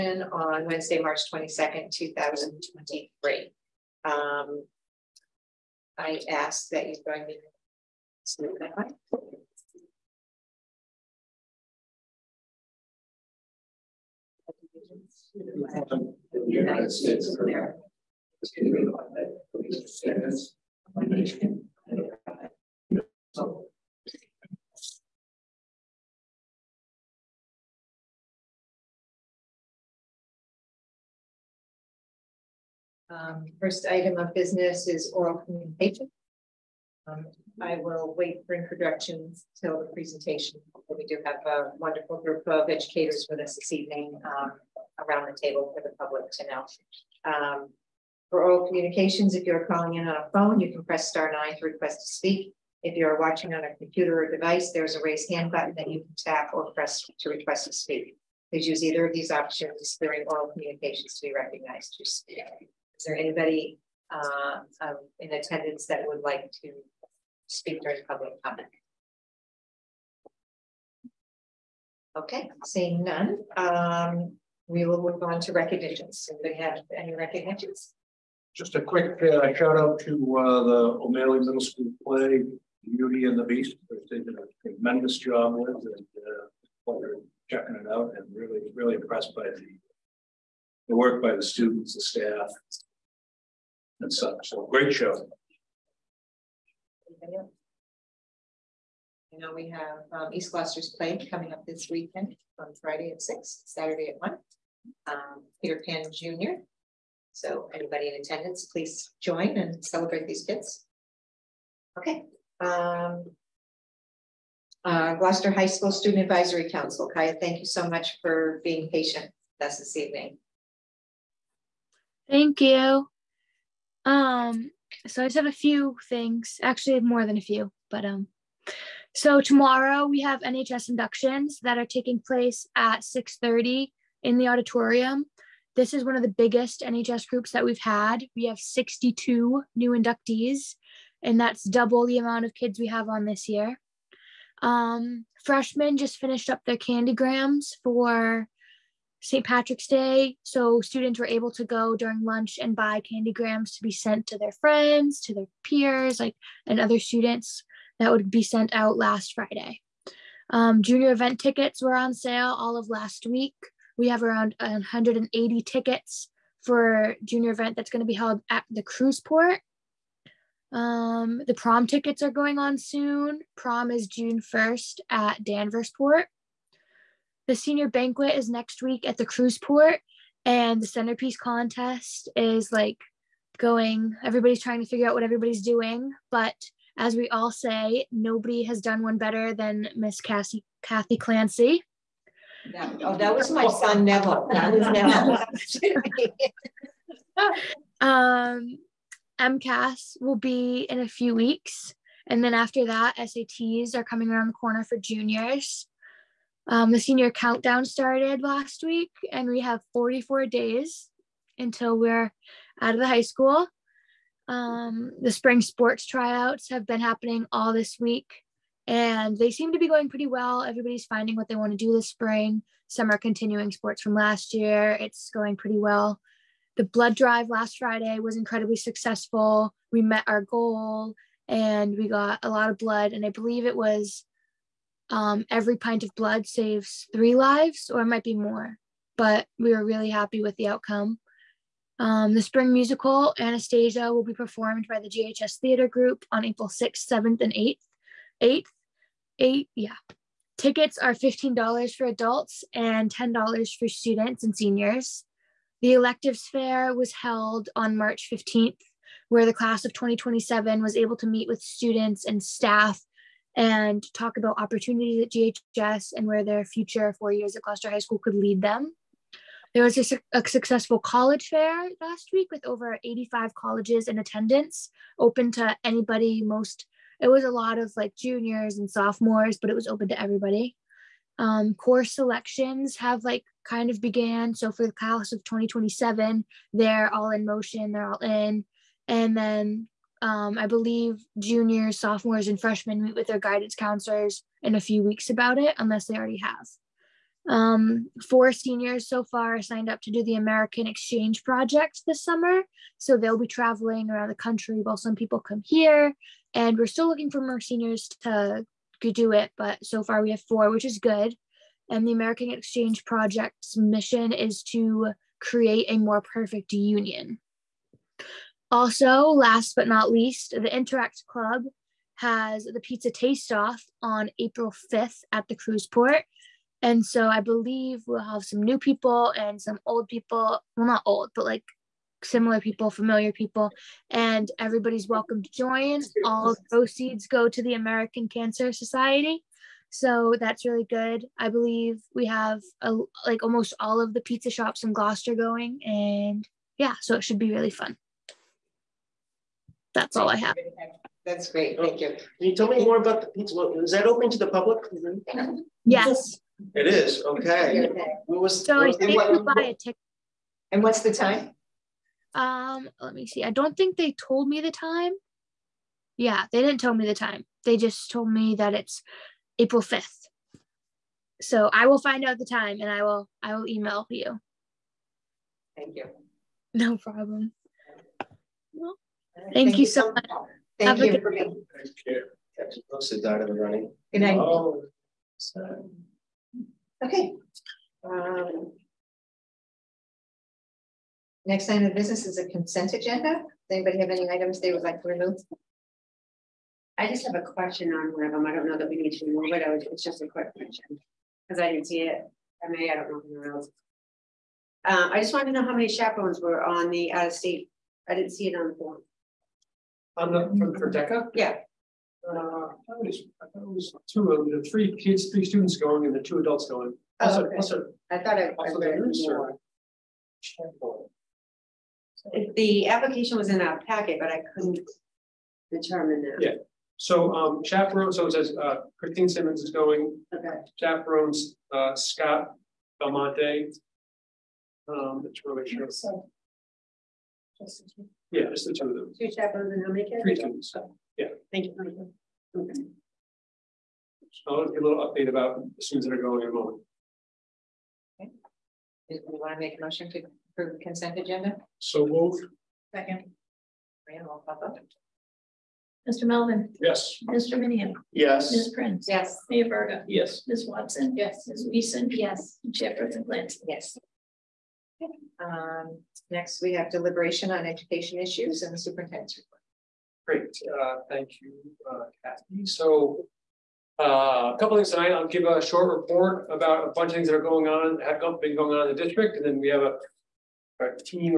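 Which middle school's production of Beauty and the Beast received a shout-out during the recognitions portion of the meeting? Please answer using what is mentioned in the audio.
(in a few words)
O'Malley Middle School.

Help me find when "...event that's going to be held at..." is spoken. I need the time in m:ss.
2:47.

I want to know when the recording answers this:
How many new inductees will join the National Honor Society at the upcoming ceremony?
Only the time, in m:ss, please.
2:18.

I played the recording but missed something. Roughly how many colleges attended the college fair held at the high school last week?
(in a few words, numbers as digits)
85.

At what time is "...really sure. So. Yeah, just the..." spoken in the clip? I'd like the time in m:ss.
7:15.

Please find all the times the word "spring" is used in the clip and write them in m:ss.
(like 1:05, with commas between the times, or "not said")
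3:35, 3:42, 4:02.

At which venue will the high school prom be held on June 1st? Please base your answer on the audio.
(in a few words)
Danversport.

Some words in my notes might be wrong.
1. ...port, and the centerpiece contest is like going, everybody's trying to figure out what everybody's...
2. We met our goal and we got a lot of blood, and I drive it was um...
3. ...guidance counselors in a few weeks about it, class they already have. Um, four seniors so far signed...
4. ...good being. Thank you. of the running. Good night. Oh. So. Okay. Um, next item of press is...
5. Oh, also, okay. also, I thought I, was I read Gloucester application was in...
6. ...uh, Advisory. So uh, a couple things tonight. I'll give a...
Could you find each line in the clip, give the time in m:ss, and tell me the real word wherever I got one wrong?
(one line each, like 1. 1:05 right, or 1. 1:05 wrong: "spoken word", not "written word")
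1. 2:59 right
2. 3:49 wrong: "believe", not "drive"
3. 4:53 wrong: "unless", not "class"
4. 6:21 wrong: "business", not "press"
5. 6:57 wrong: "The", not "Gloucester"
6. 7:51 wrong: "Kathy", not "Advisory".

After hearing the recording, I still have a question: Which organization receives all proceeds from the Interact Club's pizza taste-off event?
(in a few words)
American Cancer Society.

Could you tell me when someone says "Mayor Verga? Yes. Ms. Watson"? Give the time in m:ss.
7:39.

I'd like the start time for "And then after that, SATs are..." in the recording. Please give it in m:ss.
3:22.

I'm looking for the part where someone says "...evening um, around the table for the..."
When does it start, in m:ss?
0:43.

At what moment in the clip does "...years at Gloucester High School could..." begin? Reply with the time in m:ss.
4:27.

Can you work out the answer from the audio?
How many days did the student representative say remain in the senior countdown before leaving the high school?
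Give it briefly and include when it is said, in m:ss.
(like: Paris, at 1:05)
44, at 3:29.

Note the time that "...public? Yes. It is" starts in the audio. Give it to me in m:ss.
5:54.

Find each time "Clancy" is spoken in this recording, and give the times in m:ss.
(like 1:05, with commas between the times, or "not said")
3:11, 7:43.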